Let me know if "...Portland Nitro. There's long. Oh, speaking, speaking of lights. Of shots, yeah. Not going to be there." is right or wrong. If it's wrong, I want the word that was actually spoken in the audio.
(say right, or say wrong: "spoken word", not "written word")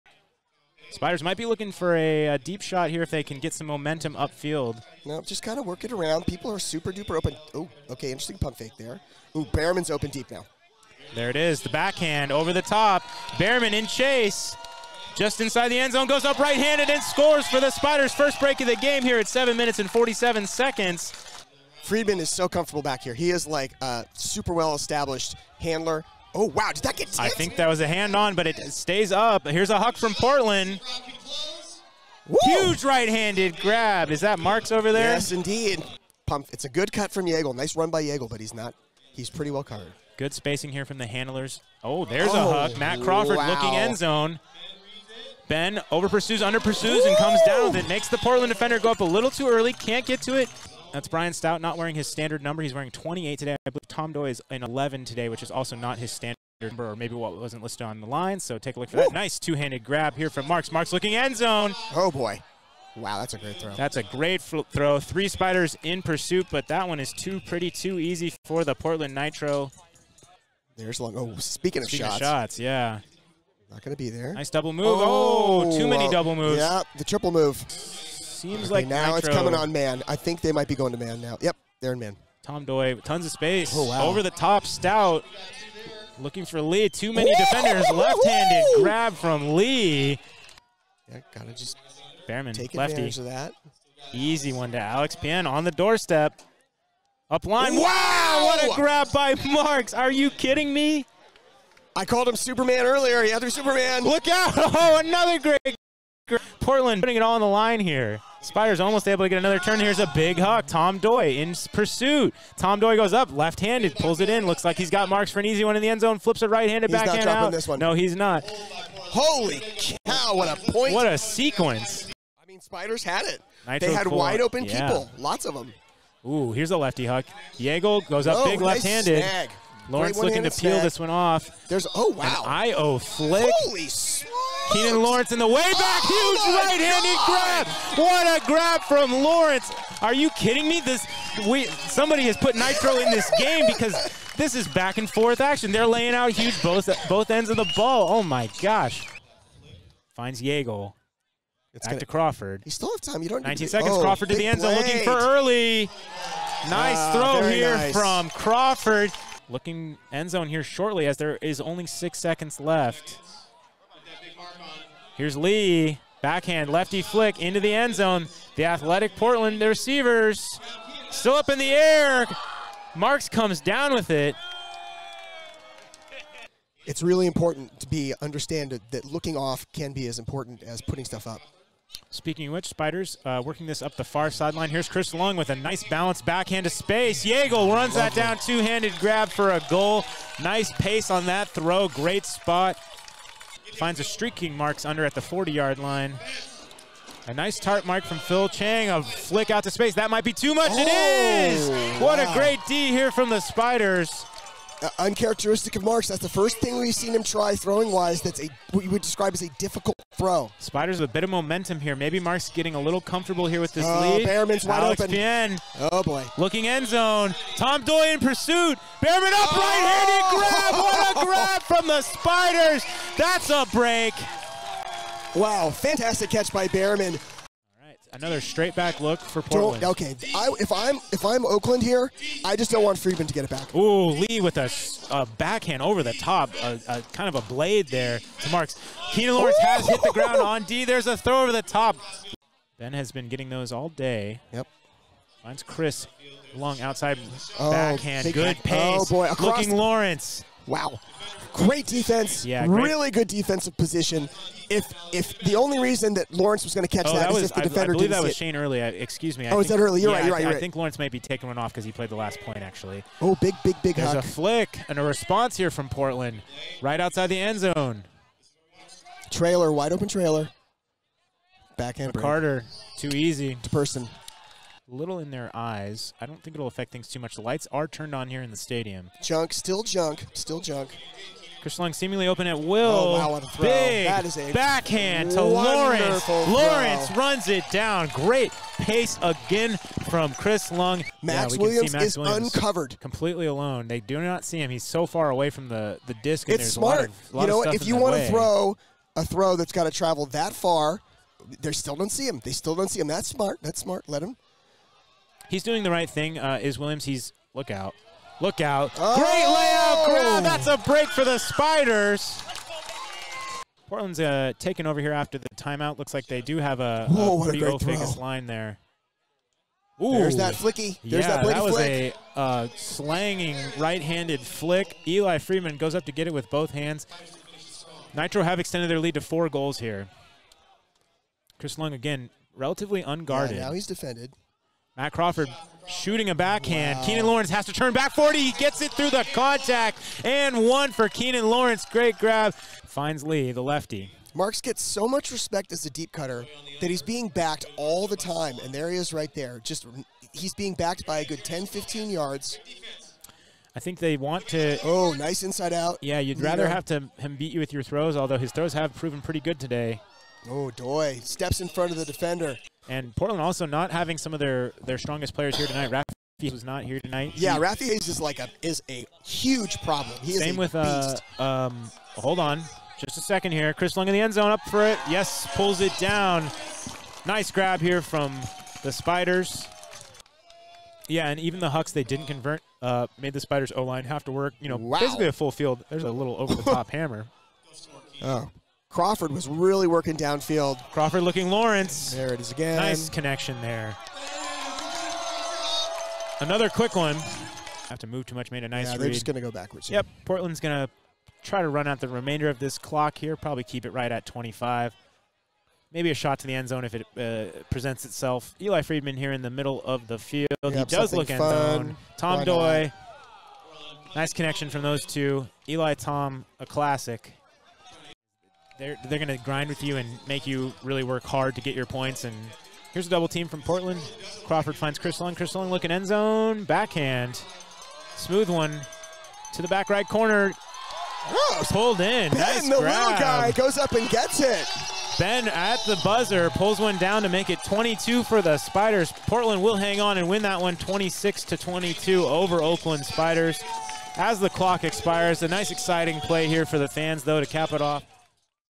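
wrong: "shots", not "lights".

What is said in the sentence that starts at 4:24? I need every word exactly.
a flick and a response here from Portland, right outside the end zone.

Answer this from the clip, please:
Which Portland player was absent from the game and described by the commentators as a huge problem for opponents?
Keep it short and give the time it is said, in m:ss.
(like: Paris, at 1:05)
Rafi Hayes, at 6:07.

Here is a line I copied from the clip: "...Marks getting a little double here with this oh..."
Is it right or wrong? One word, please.
wrong.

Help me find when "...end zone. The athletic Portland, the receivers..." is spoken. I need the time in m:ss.
2:47.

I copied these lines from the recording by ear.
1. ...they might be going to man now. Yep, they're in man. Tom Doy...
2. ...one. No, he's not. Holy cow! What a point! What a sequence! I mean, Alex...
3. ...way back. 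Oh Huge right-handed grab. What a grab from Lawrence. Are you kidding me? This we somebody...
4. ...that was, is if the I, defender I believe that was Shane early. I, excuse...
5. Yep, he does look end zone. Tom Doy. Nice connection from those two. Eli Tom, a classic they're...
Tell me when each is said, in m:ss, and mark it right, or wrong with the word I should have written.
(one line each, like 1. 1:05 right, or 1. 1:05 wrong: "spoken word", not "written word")
1. 1:20 right
2. 1:57 wrong: "Spiders", not "Alex"
3. 2:15 right
4. 4:17 right
5. 6:50 right.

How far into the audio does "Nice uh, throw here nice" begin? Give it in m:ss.
2:36.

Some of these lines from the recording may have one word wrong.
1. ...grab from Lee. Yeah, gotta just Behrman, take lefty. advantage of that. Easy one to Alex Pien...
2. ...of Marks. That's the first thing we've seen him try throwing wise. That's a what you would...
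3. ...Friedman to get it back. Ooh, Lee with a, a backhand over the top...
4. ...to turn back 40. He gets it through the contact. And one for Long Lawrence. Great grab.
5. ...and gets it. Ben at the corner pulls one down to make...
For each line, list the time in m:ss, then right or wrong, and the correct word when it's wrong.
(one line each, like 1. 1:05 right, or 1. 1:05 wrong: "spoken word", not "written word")
1. 1:28 right
2. 3:25 right
3. 3:52 right
4. 5:37 wrong: "Keenan", not "Long"
5. 7:13 wrong: "buzzer", not "corner".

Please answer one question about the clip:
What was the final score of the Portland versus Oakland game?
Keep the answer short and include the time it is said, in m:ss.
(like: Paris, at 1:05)
26 to 22, at 7:20.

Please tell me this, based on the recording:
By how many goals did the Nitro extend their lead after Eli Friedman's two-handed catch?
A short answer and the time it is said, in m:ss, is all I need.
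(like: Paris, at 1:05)
4, at 5:29.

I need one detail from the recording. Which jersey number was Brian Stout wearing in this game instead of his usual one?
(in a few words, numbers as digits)
28.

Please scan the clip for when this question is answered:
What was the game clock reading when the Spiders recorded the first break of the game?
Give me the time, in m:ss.
0:19.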